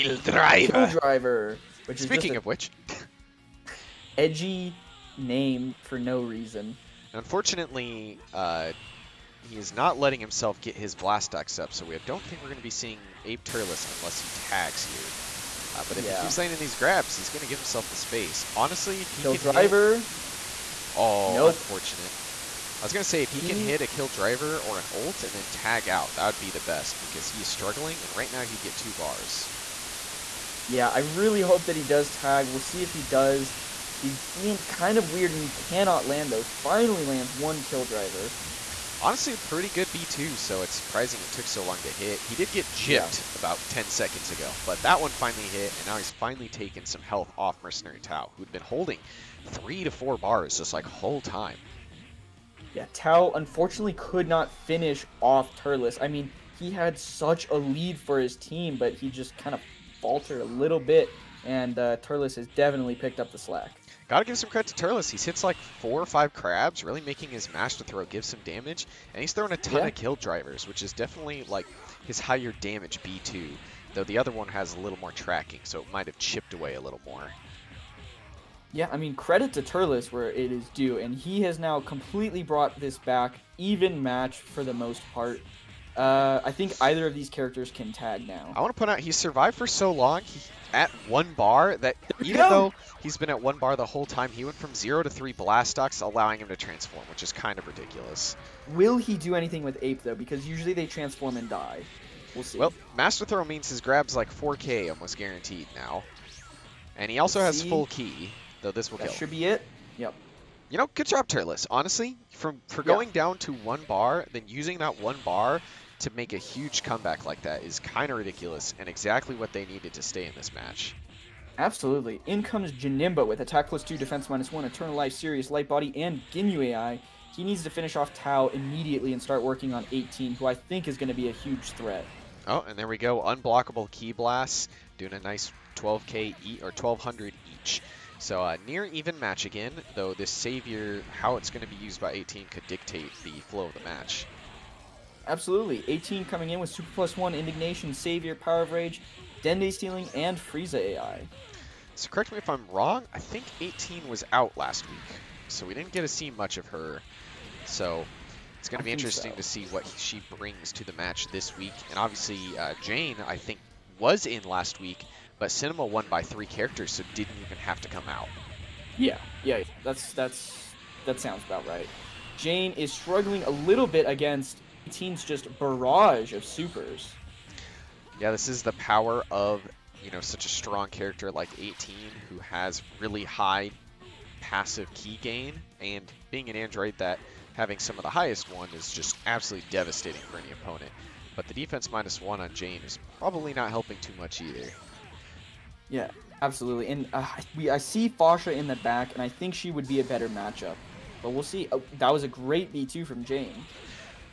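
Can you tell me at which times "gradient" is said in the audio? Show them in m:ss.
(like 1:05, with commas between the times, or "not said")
not said.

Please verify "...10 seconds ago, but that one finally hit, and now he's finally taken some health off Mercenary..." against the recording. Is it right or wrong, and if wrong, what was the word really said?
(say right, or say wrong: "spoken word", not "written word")
right.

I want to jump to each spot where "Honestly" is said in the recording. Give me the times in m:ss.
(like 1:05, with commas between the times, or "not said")
0:18, 0:39, 1:51.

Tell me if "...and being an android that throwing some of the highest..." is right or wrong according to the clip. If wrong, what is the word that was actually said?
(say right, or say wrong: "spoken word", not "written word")
wrong: "having", not "throwing".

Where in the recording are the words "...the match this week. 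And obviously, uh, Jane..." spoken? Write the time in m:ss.
2:40.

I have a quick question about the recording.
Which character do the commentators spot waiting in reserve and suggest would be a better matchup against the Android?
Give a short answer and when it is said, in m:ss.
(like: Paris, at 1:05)
Fasha, at 3:18.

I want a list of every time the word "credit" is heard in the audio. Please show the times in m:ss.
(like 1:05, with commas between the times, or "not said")
1:04, 1:19.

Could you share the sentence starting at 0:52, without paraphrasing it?
Yeah, Tao unfortunately could not finish off Turles.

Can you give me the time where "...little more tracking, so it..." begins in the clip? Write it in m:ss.
1:14.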